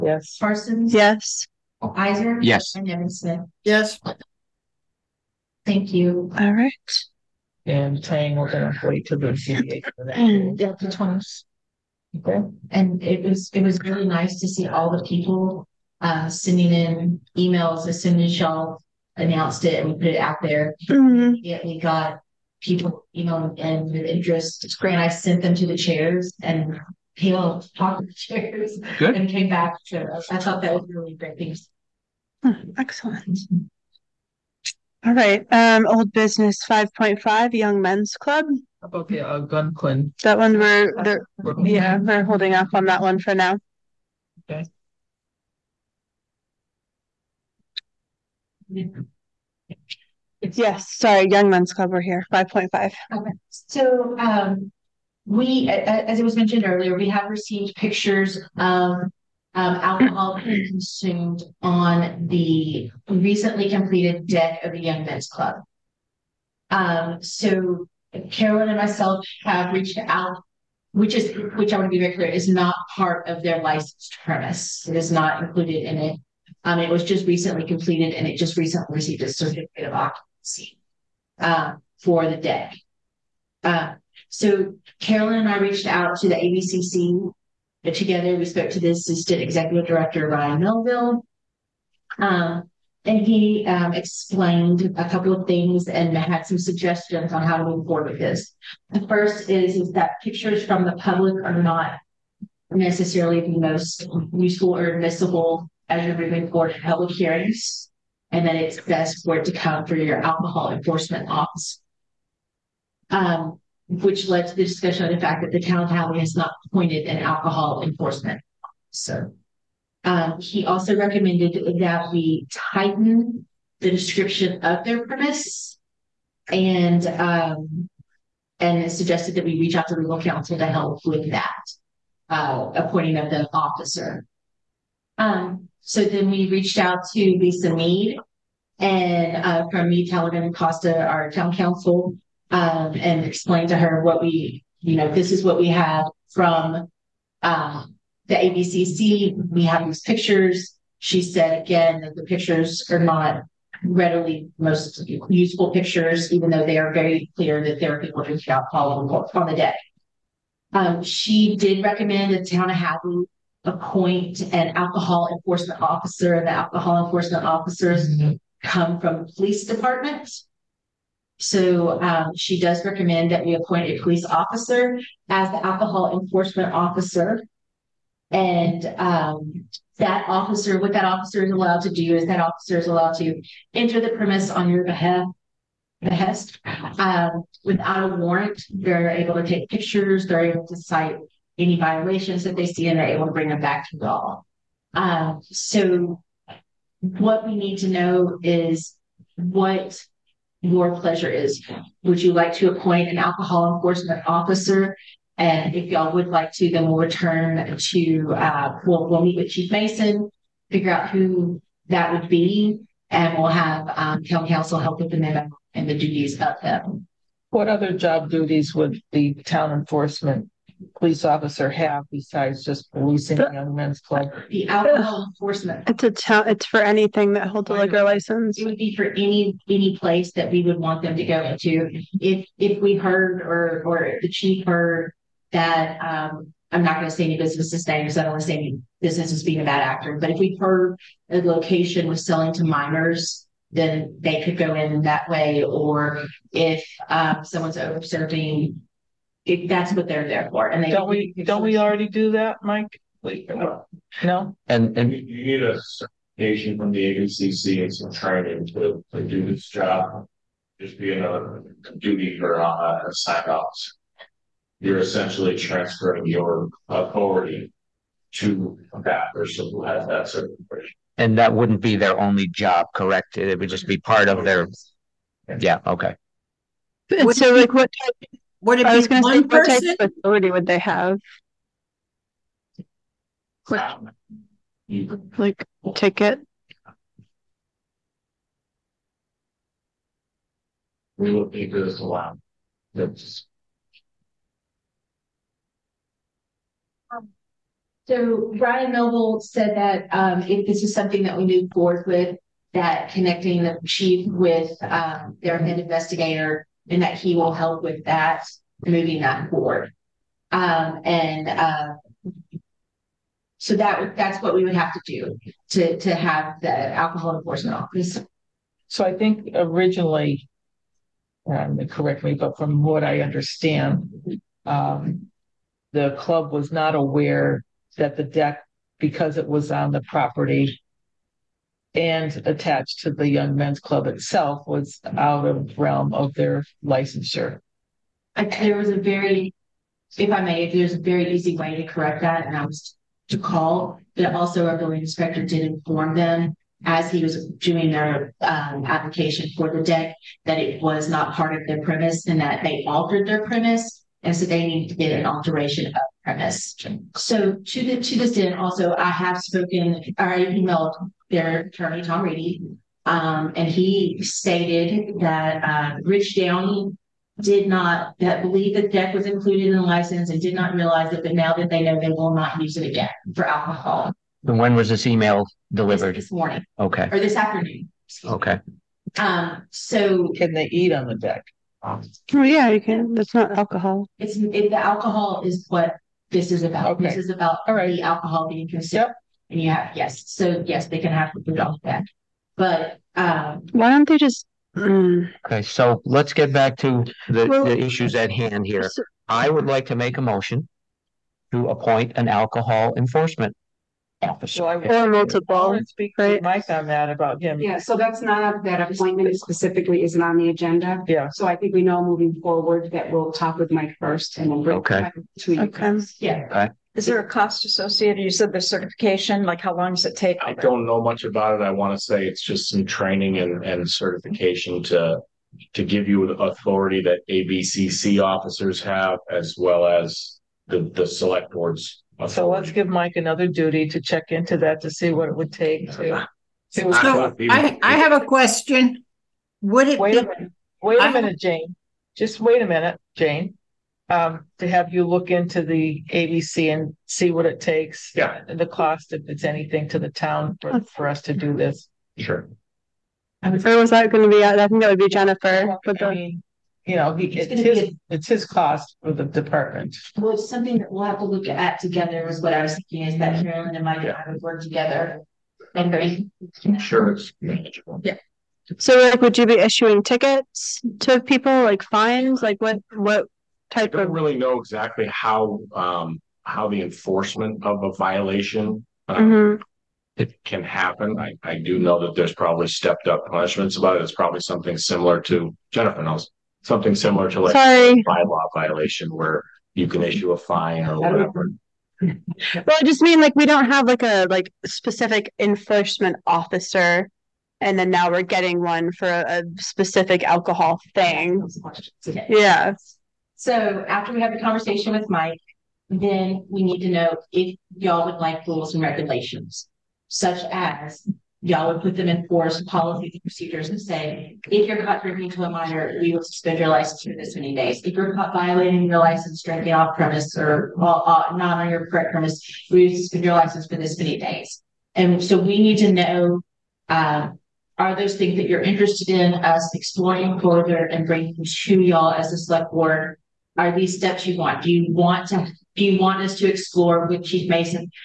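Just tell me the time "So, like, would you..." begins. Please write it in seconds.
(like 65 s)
468 s.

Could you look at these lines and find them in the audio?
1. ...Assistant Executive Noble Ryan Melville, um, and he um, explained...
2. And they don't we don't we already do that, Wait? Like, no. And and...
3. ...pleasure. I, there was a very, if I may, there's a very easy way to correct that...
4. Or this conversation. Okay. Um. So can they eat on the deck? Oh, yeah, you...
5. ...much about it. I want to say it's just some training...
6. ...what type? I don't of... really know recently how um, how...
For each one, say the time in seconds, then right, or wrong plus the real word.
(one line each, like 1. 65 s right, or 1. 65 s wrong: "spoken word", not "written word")
1. 88 s wrong: "Director", not "Noble"
2. 250 s wrong: "Mike", not "Wait"
3. 336 s wrong: "licensure", not "pleasure"
4. 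377 s wrong: "afternoon", not "conversation"
5. 421 s right
6. 472 s wrong: "exactly", not "recently".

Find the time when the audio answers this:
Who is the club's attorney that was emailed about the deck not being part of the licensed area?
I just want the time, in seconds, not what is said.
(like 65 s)
362 s.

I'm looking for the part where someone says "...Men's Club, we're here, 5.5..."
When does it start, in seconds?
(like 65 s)
51 s.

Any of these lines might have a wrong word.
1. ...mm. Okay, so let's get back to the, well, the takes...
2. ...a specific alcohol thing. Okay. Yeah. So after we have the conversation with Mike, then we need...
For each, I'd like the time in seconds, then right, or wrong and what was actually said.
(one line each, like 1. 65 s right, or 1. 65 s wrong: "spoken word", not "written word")
1. 394 s wrong: "issues", not "takes"
2. 499 s right.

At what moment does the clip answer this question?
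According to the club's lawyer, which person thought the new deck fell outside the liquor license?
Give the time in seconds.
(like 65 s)
366 s.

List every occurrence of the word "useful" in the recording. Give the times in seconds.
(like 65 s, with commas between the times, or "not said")
104 s, 155 s.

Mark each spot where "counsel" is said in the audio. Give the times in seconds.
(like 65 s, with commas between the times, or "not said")
130 s, 141 s, 214 s.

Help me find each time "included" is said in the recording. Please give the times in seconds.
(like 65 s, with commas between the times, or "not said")
75 s, 369 s.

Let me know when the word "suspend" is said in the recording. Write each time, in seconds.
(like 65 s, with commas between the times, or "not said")
516 s, 522 s.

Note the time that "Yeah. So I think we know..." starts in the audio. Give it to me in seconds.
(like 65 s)
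411 s.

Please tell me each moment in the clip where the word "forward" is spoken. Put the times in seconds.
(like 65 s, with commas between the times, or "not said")
97 s, 106 s, 301 s, 309 s, 412 s.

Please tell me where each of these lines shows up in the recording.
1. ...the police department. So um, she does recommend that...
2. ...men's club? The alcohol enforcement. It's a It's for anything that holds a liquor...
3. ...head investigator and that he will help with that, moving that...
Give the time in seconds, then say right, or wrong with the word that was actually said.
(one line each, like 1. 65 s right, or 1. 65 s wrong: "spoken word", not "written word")
1. 169 s right
2. 223 s right
3. 305 s right.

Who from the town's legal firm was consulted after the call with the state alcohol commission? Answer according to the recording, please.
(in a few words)
Lisa Mead.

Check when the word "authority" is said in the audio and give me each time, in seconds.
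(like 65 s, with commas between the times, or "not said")
266 s, 426 s.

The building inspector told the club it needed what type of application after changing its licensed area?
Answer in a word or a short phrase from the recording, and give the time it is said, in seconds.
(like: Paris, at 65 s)
alteration of premise, at 355 s.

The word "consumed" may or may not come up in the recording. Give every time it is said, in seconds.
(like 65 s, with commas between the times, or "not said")
60 s, 388 s.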